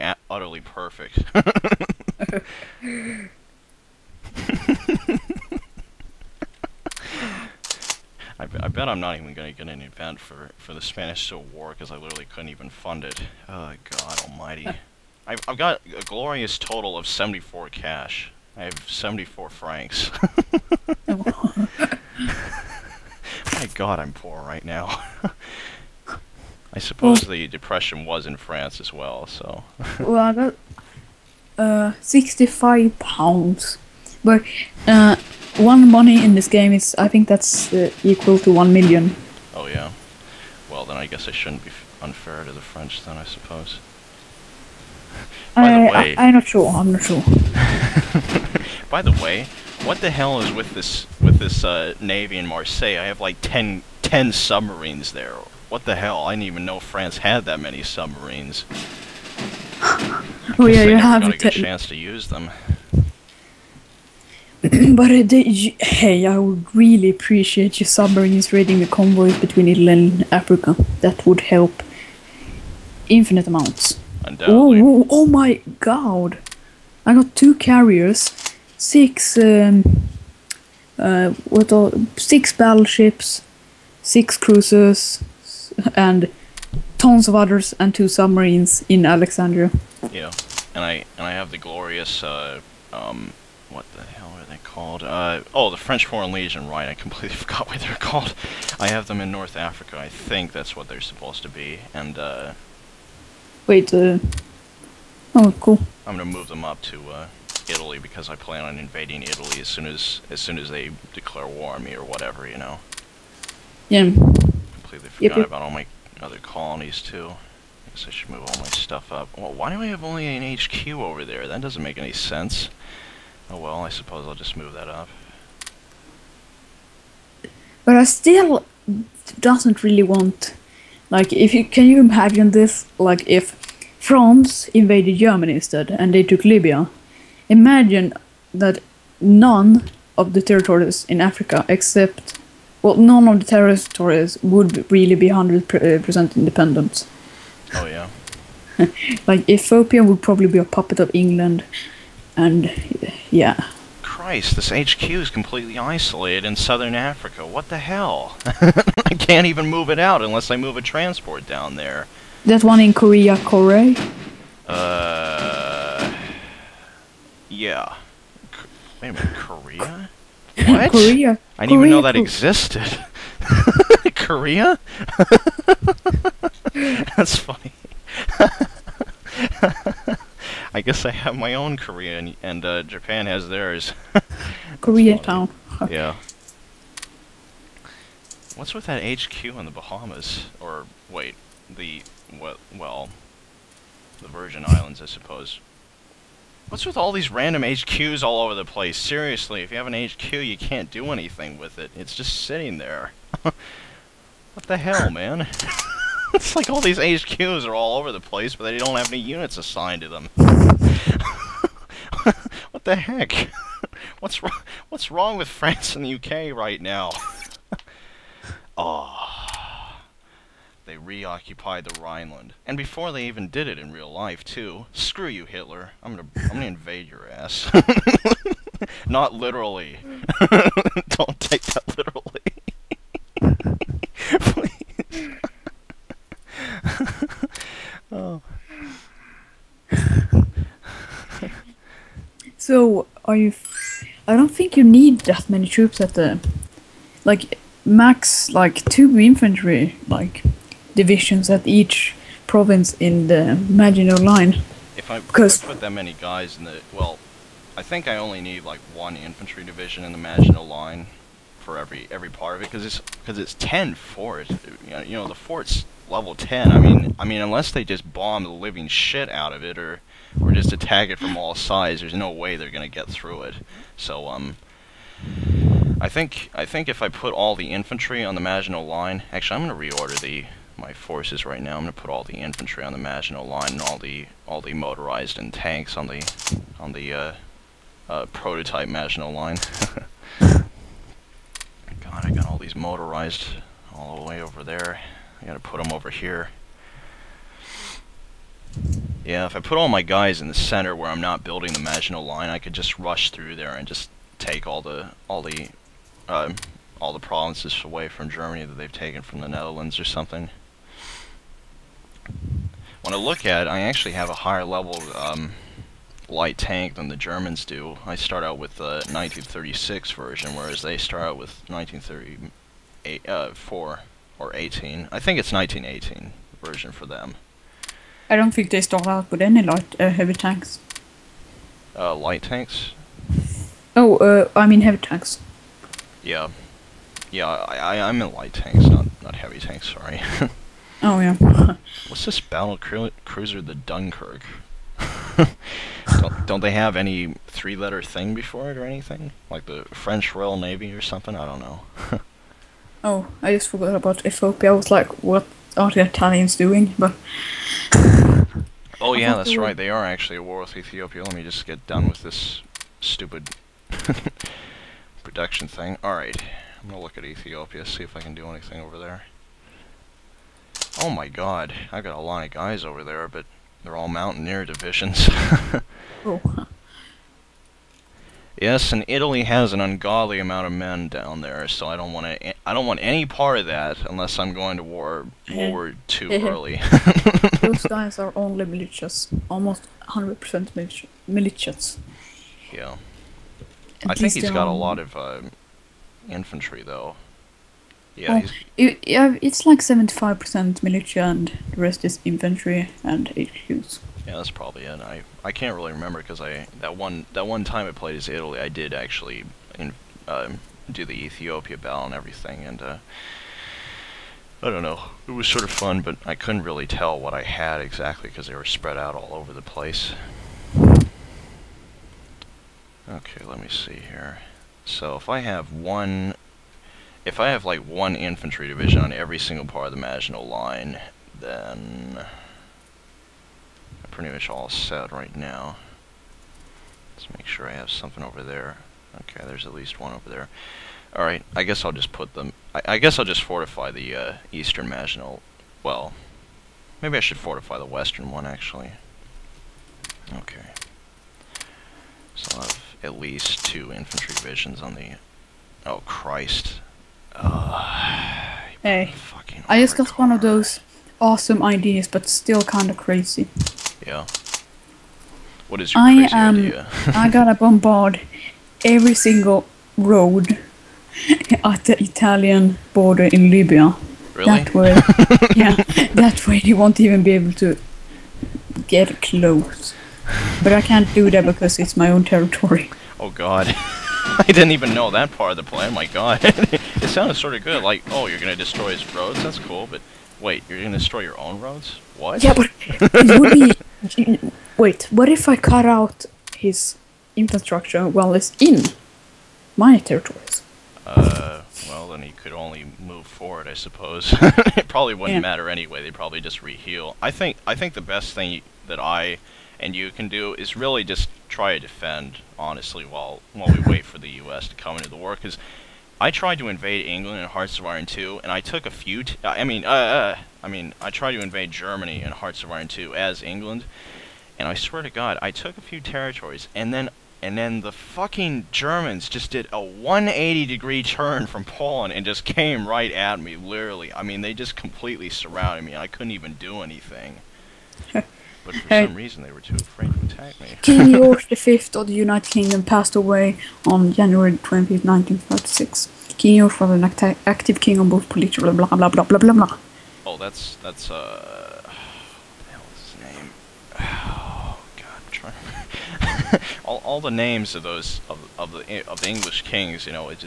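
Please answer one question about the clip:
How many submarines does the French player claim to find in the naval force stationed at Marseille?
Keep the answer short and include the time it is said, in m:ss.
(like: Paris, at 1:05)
10, at 0:53.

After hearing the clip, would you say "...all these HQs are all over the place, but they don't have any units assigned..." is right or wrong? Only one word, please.
right.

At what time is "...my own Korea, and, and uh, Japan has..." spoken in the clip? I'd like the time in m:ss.
3:01.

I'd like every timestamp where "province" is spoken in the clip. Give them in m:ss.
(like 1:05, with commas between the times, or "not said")
4:12, 5:07.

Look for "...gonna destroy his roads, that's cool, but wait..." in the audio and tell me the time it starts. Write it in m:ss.
8:08.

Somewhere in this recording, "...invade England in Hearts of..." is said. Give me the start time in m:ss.
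8:36.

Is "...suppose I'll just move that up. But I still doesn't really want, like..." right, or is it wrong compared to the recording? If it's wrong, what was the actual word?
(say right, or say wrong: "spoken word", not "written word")
right.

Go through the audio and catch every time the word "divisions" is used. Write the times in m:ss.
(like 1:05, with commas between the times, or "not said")
4:10, 4:19, 6:14, 7:08, 7:34.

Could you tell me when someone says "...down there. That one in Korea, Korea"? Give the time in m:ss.
2:41.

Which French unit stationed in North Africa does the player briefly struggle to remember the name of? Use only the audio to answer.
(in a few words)
French Foreign Legion.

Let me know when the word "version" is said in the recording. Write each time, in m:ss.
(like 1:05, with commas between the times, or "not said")
5:20, 5:26.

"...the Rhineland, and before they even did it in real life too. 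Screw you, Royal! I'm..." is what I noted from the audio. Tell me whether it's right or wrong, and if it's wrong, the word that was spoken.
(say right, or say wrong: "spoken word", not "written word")
wrong: "Hitler", not "Royal".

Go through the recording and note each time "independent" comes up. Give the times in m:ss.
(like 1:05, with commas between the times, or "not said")
2:26.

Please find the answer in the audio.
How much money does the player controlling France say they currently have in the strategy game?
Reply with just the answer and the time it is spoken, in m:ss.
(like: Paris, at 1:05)
74 francs, at 0:18.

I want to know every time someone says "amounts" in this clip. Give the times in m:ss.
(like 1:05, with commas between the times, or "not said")
1:13, 6:20.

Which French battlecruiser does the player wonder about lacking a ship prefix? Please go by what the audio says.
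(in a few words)
Dunkirk.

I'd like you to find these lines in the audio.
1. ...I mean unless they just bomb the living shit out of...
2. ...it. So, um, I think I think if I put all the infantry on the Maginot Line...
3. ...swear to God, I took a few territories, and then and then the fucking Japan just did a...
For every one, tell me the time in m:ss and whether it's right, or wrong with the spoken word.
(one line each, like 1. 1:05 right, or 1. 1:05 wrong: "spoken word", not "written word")
1. 4:27 right
2. 4:33 right
3. 8:44 wrong: "Germans", not "Japan".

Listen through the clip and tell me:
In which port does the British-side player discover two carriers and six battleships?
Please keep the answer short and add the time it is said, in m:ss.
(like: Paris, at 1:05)
Alexandria, at 1:29.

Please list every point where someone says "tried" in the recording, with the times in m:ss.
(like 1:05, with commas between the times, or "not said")
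8:36, 8:41.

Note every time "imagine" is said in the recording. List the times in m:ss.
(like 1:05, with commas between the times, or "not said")
2:11, 2:17.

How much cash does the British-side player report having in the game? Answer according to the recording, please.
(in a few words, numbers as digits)
65 pounds.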